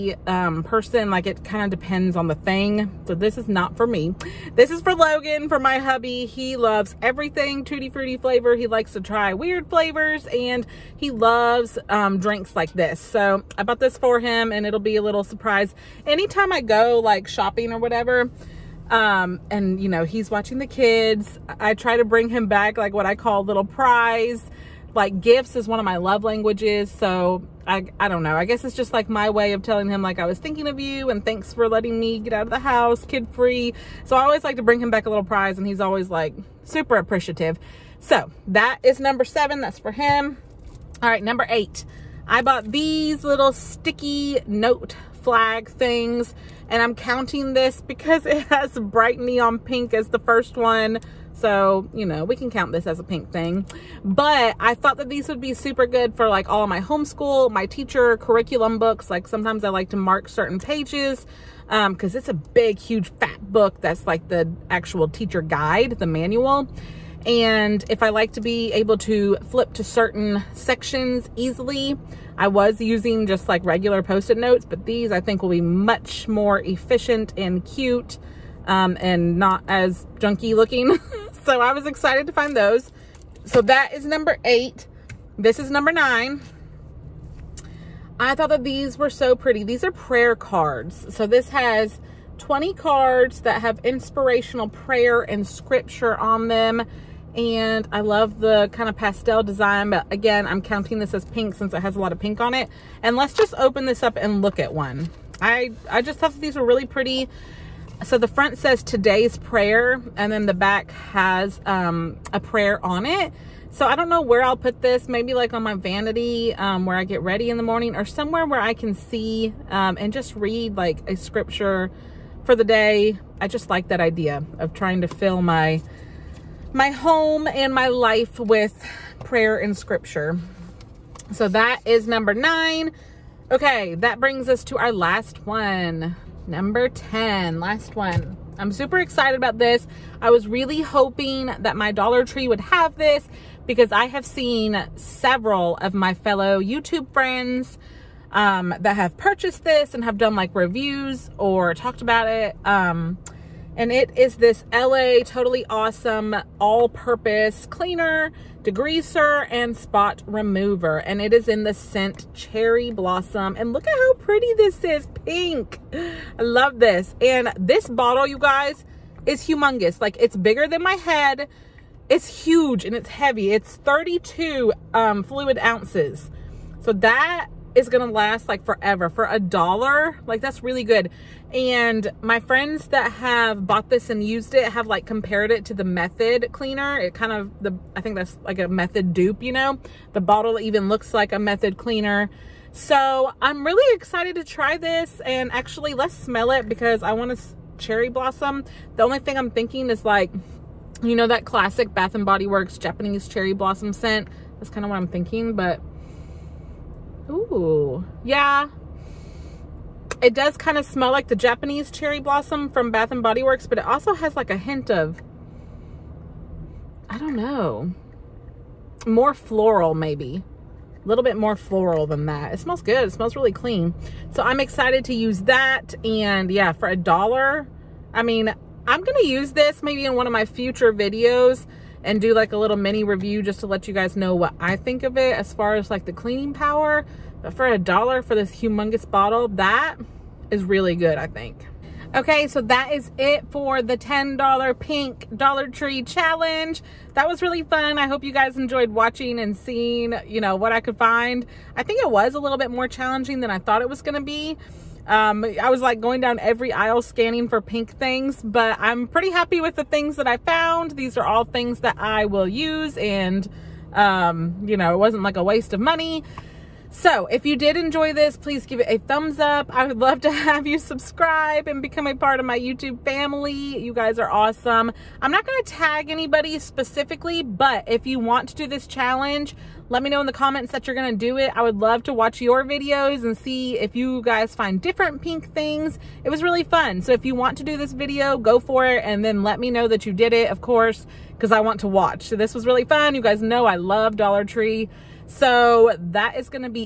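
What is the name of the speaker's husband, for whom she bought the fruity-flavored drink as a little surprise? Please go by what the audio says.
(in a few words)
Logan.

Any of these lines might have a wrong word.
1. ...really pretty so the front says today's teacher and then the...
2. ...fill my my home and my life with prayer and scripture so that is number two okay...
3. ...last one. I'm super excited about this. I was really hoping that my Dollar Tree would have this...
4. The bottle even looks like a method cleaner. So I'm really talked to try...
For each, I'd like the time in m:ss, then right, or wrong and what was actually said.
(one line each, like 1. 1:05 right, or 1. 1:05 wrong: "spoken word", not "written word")
1. 1:46 wrong: "prayer", not "teacher"
2. 2:05 wrong: "nine", not "two"
3. 2:17 right
4. 3:10 wrong: "excited", not "talked".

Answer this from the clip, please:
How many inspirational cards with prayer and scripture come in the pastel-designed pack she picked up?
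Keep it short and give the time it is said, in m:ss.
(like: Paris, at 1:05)
20, at 1:32.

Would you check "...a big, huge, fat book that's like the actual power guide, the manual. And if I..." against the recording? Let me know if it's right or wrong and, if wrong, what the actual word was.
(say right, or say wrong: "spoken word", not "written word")
wrong: "teacher", not "power".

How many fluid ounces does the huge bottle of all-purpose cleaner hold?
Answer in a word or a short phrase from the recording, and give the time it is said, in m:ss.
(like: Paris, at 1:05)
32, at 2:53.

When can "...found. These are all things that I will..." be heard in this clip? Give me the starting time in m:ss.
4:20.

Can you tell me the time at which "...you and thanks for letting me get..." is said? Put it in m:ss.
0:30.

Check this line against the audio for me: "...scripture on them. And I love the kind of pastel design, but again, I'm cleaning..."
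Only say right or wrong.
wrong.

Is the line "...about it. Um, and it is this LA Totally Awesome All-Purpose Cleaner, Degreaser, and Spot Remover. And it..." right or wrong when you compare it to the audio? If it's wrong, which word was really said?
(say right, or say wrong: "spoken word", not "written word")
right.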